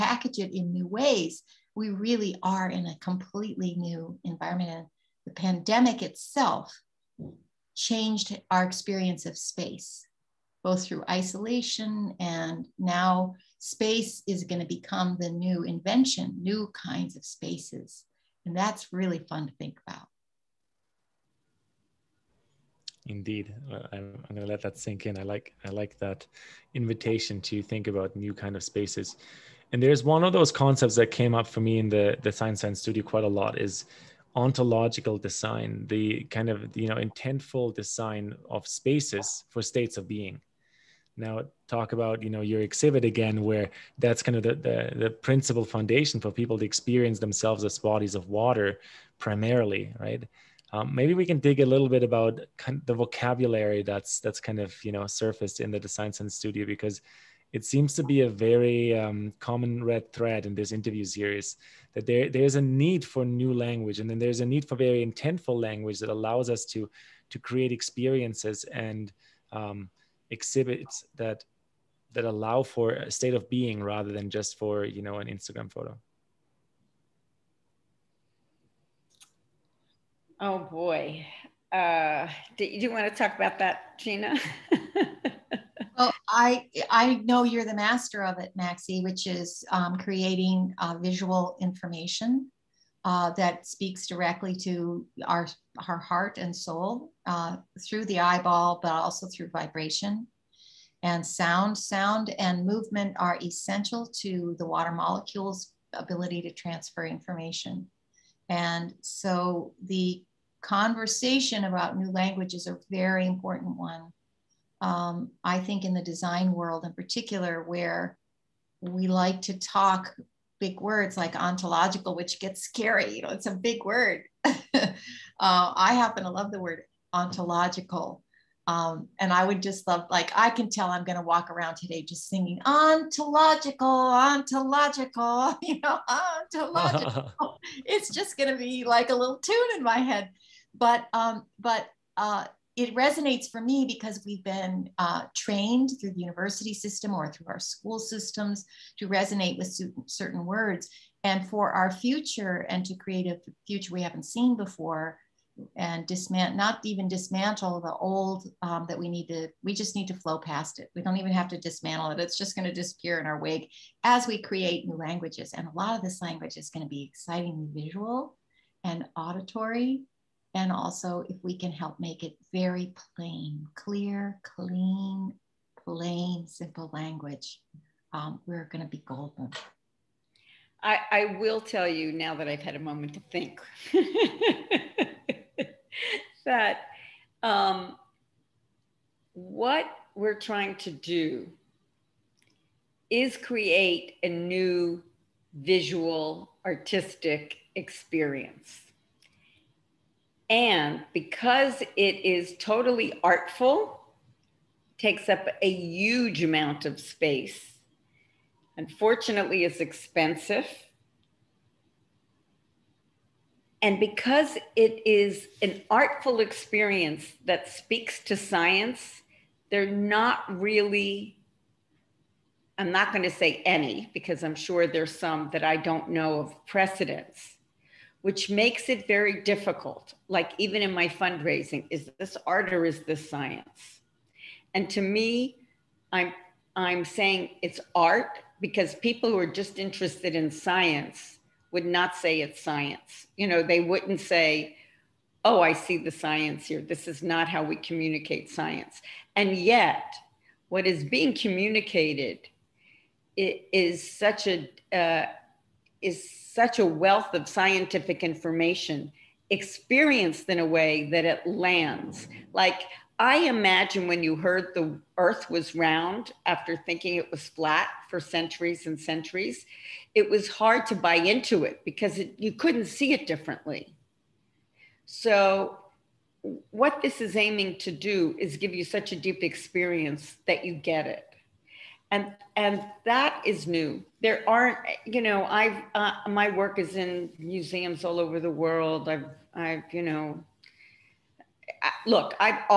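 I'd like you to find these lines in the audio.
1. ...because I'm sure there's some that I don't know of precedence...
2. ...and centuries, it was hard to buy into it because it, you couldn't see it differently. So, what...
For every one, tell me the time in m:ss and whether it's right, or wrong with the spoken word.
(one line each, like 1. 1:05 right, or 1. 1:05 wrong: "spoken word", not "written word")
1. 3:44 right
2. 4:28 right.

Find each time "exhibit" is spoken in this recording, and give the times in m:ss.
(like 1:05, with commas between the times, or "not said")
0:42, 1:10.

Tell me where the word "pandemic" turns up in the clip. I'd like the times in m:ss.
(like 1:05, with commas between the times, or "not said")
0:05.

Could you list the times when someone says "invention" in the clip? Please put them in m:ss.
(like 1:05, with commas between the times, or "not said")
0:15.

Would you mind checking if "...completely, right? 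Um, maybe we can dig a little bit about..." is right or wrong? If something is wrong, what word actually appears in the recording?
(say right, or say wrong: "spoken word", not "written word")
wrong: "primarily", not "completely".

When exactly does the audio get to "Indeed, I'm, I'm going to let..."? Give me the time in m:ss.
0:23.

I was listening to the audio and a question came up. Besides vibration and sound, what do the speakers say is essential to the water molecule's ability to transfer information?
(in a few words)
movement.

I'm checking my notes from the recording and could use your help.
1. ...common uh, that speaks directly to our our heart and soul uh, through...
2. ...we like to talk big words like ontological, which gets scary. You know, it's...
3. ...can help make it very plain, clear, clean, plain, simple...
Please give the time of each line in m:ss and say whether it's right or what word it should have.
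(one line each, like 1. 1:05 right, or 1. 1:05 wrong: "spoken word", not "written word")
1. 1:31 wrong: "information", not "common"
2. 1:58 right
3. 2:51 right.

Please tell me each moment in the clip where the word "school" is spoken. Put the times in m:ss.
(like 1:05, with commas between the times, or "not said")
2:27.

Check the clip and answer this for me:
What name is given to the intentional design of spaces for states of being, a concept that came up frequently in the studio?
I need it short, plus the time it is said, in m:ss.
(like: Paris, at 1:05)
ontological design, at 0:34.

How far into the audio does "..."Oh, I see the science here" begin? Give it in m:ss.
4:05.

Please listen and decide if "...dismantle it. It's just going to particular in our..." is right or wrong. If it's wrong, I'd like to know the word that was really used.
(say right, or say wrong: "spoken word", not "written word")
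wrong: "disappear", not "particular".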